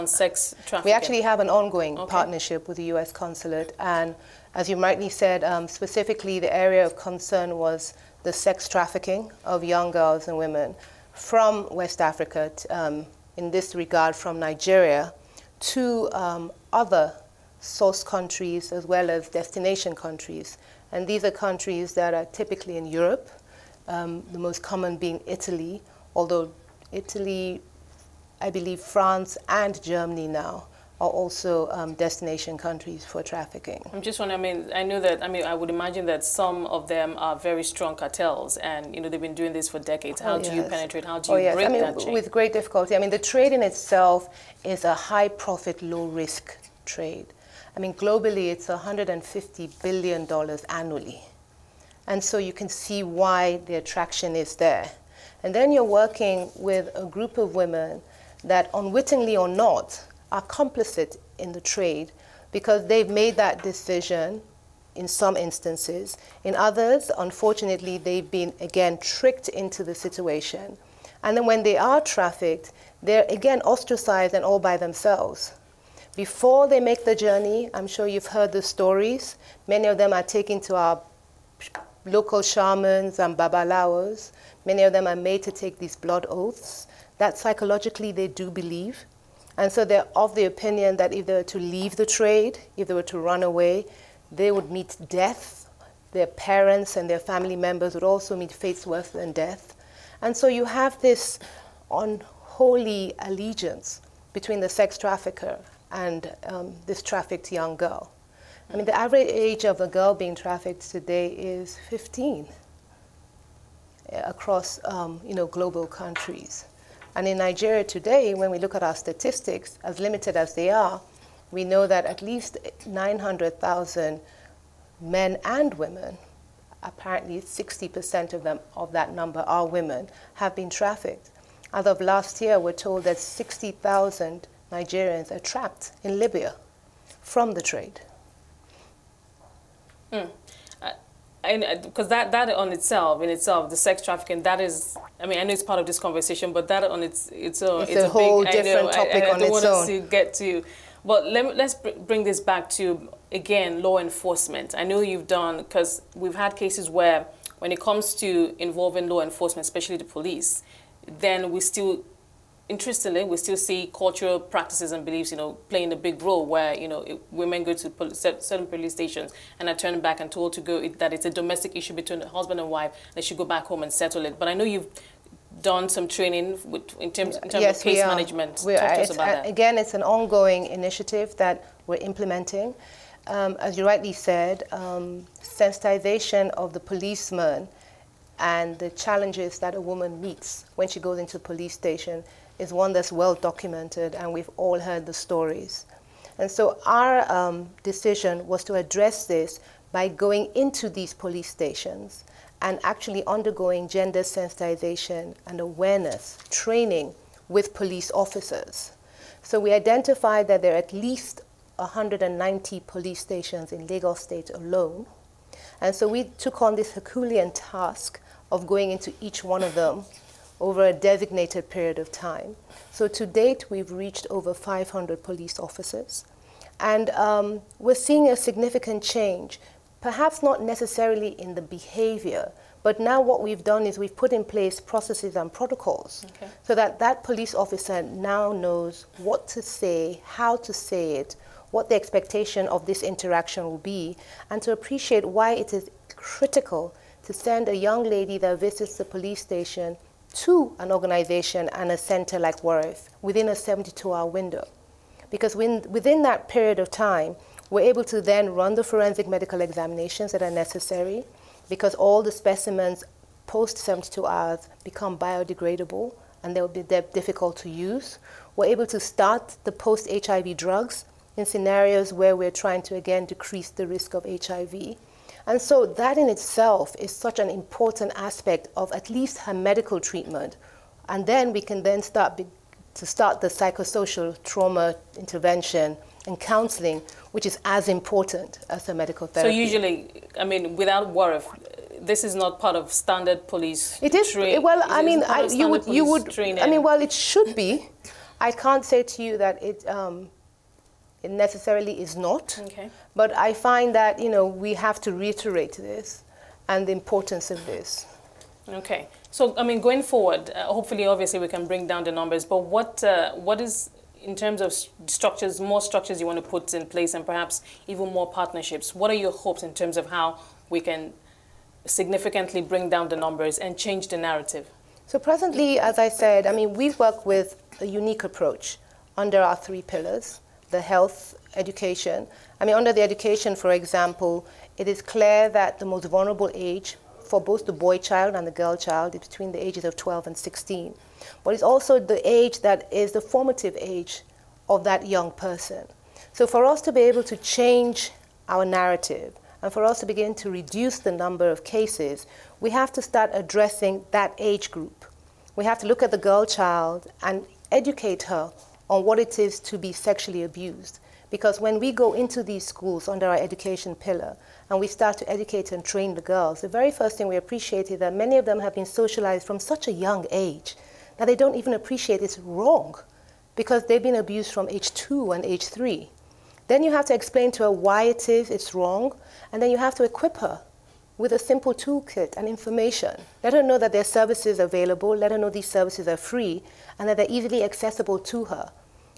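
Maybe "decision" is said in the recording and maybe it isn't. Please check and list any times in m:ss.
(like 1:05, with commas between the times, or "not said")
1:03, 3:17.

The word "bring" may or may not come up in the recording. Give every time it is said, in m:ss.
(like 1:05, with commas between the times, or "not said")
2:32, 5:11, 5:22.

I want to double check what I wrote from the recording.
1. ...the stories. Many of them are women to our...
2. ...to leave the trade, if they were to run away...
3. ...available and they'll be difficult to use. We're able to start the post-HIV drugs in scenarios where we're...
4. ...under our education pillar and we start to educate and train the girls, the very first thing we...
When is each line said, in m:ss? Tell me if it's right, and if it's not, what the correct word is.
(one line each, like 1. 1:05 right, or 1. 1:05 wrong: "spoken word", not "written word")
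1. 1:18 wrong: "taken", not "women"
2. 1:31 right
3. 4:25 wrong: "biodegradable", not "available"
4. 6:03 right.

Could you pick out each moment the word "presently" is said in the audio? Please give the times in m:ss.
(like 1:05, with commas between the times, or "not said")
5:25.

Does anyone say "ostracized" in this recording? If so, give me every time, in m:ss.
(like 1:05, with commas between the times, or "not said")
1:13.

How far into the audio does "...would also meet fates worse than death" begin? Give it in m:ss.
1:37.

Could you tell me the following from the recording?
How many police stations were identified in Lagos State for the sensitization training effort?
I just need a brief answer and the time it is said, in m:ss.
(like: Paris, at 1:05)
190, at 3:31.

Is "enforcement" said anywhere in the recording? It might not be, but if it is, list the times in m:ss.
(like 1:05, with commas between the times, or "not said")
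2:33, 2:39.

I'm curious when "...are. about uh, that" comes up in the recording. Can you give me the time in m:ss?
2:58.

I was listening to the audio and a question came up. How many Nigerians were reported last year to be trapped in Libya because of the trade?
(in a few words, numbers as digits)
60,000.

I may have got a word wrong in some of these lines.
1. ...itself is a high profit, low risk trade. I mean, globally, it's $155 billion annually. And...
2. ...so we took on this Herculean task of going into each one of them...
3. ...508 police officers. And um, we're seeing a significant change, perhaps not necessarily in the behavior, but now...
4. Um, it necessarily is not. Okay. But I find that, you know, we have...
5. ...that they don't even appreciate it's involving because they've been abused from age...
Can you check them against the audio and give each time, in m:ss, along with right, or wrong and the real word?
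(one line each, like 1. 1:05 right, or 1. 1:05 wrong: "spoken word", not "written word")
1. 0:43 wrong: "150", not "155"
2. 3:35 right
3. 3:44 wrong: "500", not "508"
4. 4:59 right
5. 6:11 wrong: "wrong", not "involving".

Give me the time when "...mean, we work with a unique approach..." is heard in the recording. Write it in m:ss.
5:26.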